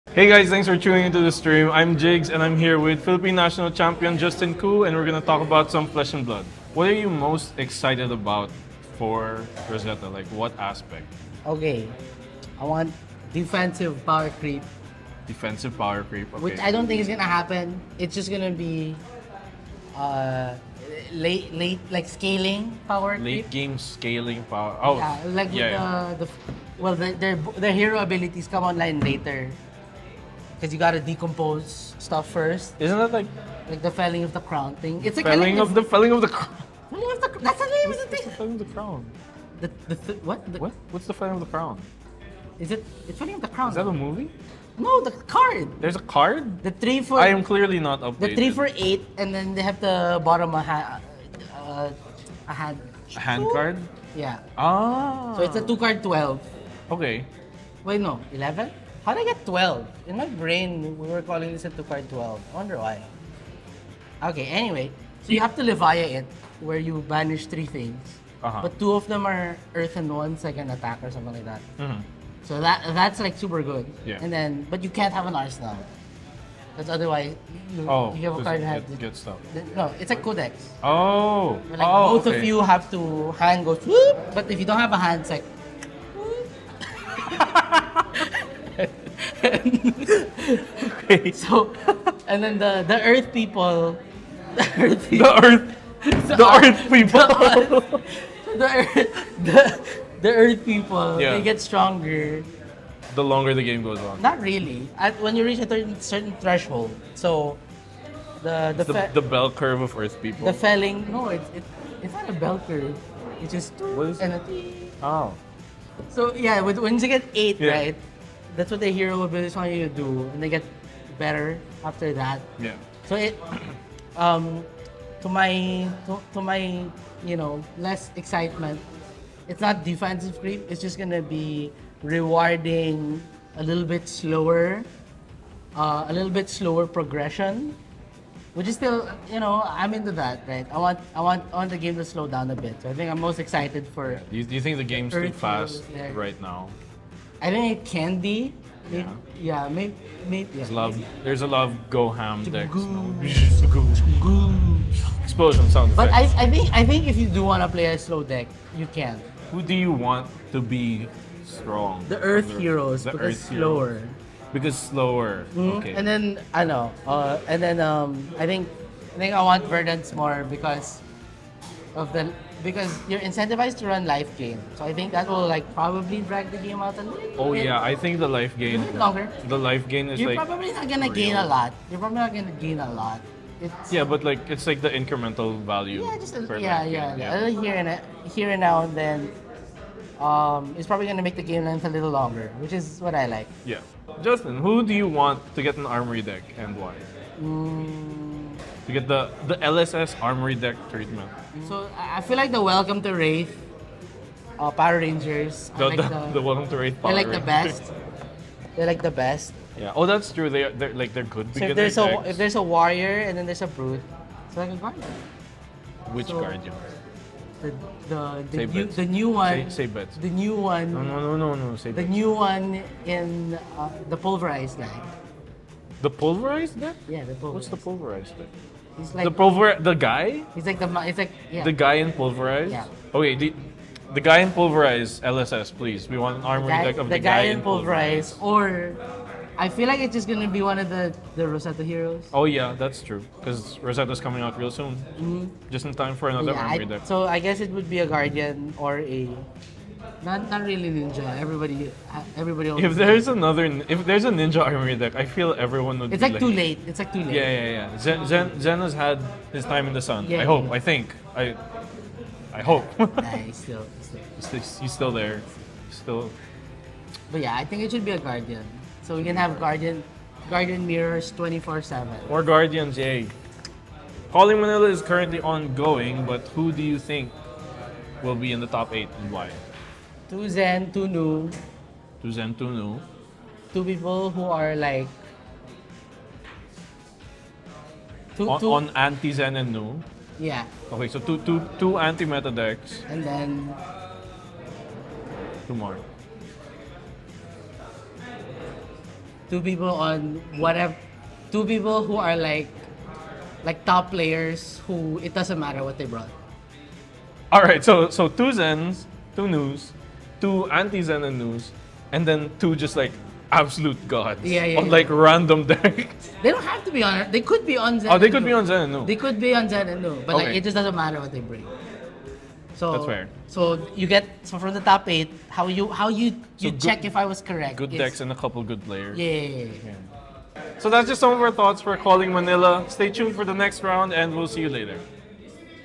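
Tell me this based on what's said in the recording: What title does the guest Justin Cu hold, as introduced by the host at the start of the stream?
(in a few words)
Philippine national champion.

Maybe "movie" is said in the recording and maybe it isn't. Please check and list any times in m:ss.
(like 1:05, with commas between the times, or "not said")
0:44.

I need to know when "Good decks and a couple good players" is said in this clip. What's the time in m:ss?
5:27.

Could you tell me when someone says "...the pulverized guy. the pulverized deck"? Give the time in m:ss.
3:44.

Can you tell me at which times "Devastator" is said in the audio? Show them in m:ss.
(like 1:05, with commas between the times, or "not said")
not said.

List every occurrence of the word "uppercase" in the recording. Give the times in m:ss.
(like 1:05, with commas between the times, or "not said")
not said.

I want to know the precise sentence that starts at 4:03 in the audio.
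Because Rosetta's coming out real soon.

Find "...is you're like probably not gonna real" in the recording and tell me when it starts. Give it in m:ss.
3:00.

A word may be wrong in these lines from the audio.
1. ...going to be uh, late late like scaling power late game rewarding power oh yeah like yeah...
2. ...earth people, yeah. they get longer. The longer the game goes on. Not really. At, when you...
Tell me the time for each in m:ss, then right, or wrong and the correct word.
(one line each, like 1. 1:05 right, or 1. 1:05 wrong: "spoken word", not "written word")
1. 0:18 wrong: "scaling", not "rewarding"
2. 1:40 wrong: "stronger", not "longer".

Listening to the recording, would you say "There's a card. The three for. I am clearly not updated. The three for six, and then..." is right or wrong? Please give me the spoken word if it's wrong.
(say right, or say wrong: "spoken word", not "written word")
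wrong: "eight", not "six".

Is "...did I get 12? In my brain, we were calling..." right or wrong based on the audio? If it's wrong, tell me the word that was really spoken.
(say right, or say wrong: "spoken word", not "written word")
right.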